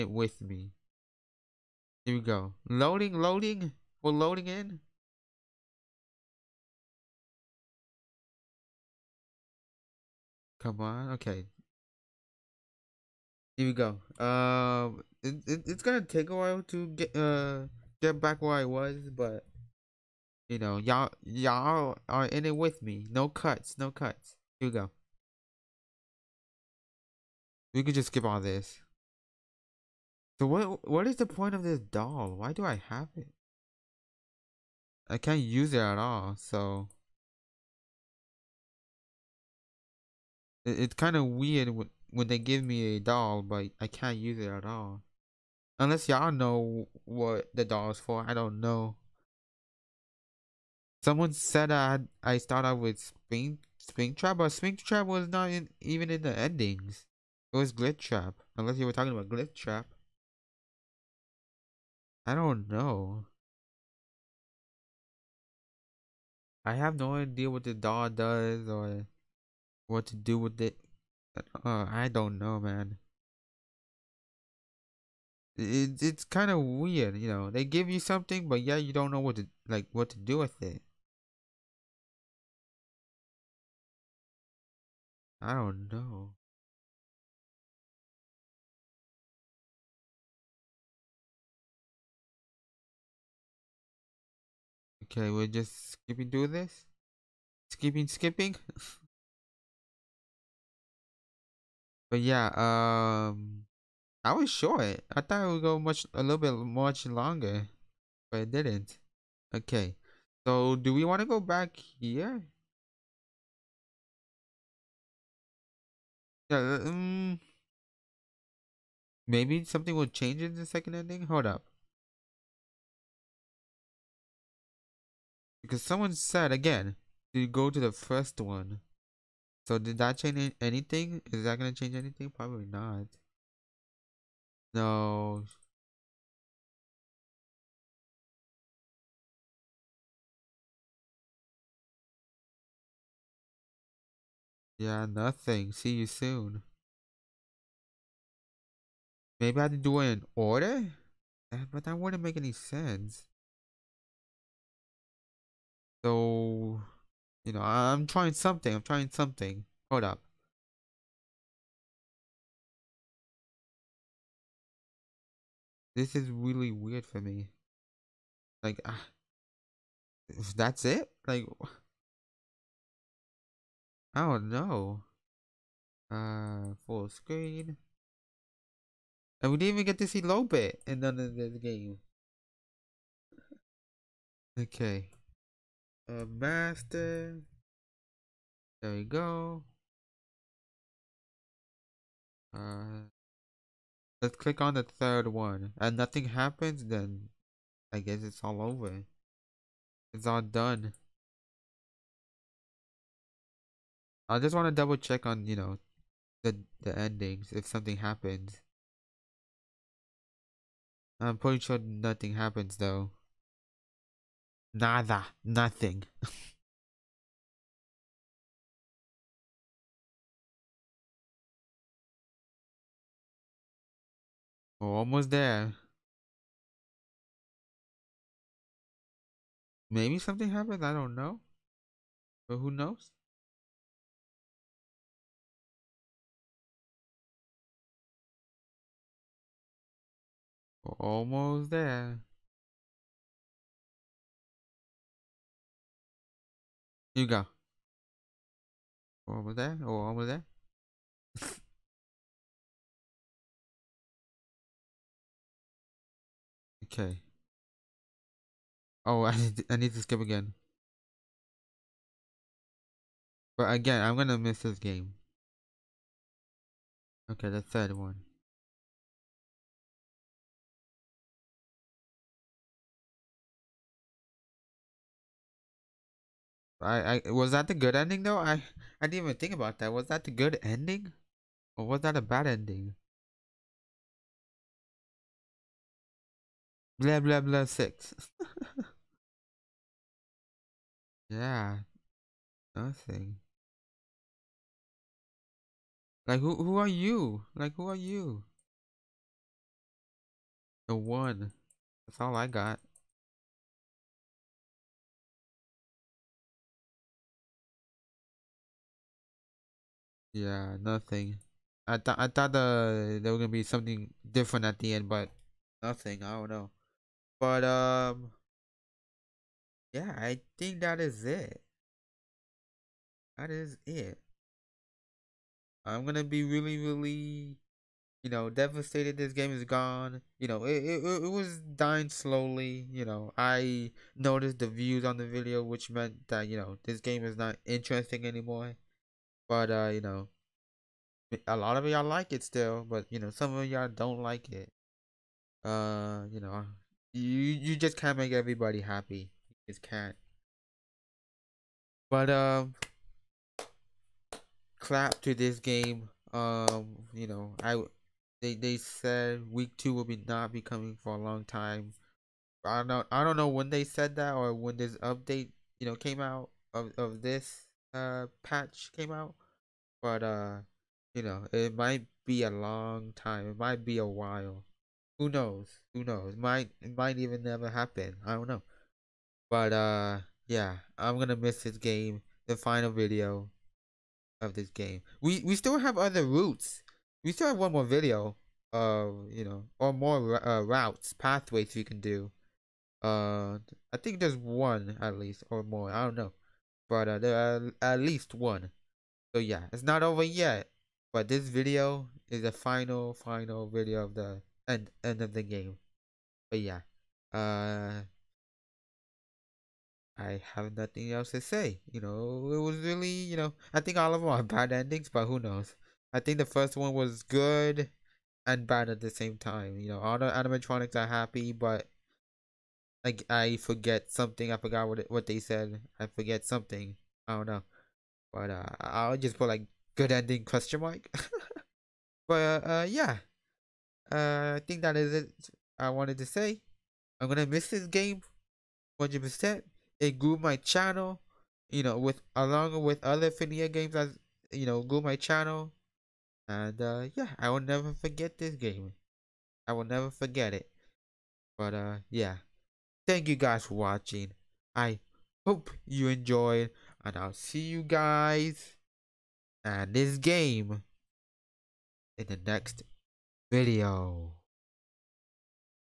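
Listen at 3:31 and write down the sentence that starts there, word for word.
I'm pretty sure nothing happens though.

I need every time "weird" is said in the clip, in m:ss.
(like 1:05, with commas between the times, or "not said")
0:41, 1:16, 2:46.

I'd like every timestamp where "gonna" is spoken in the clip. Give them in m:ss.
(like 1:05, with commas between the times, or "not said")
0:15, 2:11, 4:24, 5:13, 5:26, 6:21, 7:17.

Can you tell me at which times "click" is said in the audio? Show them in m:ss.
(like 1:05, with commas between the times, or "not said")
3:14.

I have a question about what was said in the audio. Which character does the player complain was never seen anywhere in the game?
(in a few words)
Lope.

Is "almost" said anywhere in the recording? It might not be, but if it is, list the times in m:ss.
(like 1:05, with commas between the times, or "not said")
3:44, 4:00.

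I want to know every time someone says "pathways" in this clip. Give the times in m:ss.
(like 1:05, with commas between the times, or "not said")
6:31.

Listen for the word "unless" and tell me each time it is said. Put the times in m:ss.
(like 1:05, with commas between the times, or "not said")
0:45, 0:58.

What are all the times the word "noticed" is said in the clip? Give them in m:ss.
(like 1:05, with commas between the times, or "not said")
5:34.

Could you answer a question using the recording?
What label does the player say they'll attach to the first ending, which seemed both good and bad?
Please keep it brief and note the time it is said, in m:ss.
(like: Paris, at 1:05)
good ending question mark, at 7:09.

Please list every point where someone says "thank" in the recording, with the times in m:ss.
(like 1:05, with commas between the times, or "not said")
7:33.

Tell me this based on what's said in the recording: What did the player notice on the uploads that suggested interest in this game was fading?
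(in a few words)
the views.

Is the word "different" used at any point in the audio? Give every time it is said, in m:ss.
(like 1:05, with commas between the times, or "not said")
5:14.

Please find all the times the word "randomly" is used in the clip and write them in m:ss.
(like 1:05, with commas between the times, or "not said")
not said.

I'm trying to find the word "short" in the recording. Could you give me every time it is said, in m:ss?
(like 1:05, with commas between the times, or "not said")
1:44.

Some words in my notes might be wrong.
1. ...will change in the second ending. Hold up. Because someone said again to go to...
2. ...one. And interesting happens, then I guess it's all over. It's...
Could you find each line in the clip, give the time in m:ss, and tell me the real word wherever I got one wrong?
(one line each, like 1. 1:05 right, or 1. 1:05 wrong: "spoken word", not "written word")
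1. 1:59 right
2. 3:15 wrong: "nothing", not "interesting".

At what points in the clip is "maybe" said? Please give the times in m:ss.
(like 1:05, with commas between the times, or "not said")
1:59, 2:29, 3:49.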